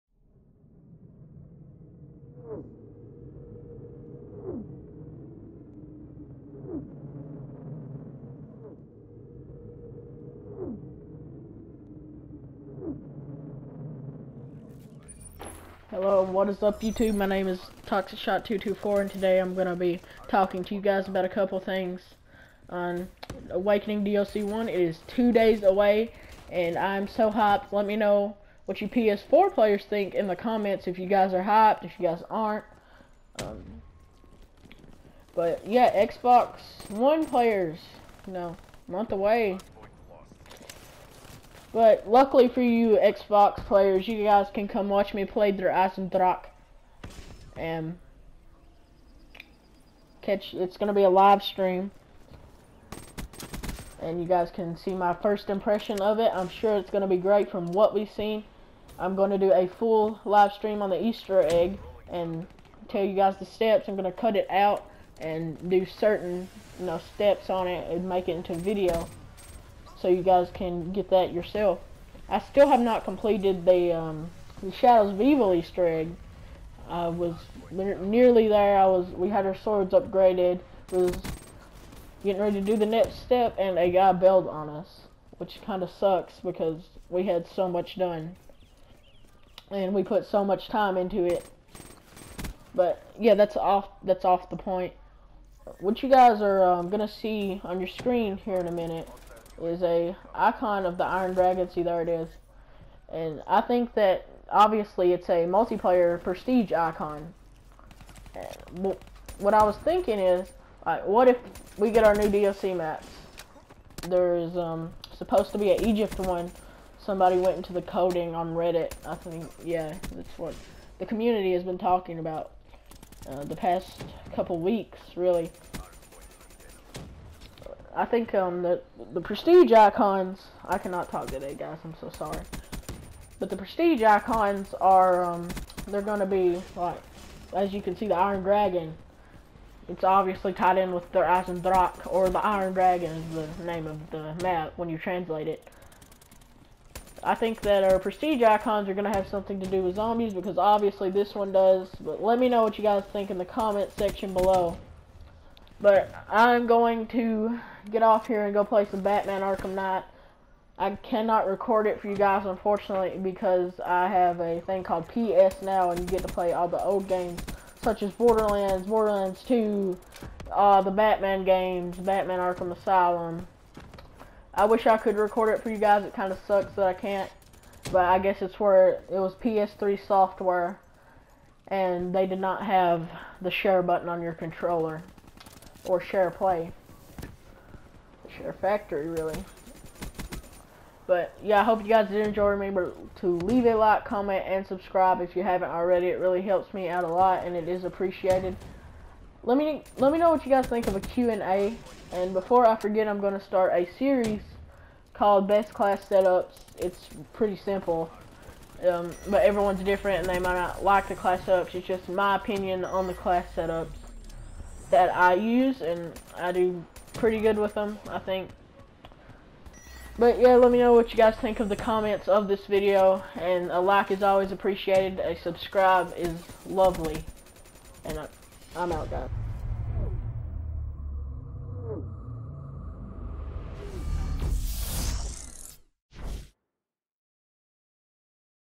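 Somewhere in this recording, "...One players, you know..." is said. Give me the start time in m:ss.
0:36.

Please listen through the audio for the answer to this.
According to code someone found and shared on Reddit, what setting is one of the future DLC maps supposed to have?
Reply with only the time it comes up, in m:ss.
1:55.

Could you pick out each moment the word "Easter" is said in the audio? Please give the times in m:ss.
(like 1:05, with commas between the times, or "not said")
1:01, 1:15.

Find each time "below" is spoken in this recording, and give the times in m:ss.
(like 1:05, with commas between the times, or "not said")
2:34.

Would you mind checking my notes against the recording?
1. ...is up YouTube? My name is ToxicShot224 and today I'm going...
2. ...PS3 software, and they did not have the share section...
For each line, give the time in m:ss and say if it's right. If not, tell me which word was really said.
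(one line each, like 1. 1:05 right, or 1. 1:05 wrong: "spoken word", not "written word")
1. 0:16 right
2. 2:59 wrong: "button", not "section".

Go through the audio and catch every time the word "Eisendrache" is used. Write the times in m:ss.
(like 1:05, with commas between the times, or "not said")
0:45, 2:21.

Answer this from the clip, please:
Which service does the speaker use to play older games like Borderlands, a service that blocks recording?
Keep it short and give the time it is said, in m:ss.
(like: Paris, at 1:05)
PS Now, at 2:45.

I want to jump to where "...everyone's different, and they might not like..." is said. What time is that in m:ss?
3:29.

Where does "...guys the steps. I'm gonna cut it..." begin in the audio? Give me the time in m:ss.
1:03.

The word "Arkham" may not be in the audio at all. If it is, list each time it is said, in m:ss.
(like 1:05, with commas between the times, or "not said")
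2:39, 2:52.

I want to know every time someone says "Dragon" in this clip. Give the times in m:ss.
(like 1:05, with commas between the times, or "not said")
1:41, 2:18, 2:22.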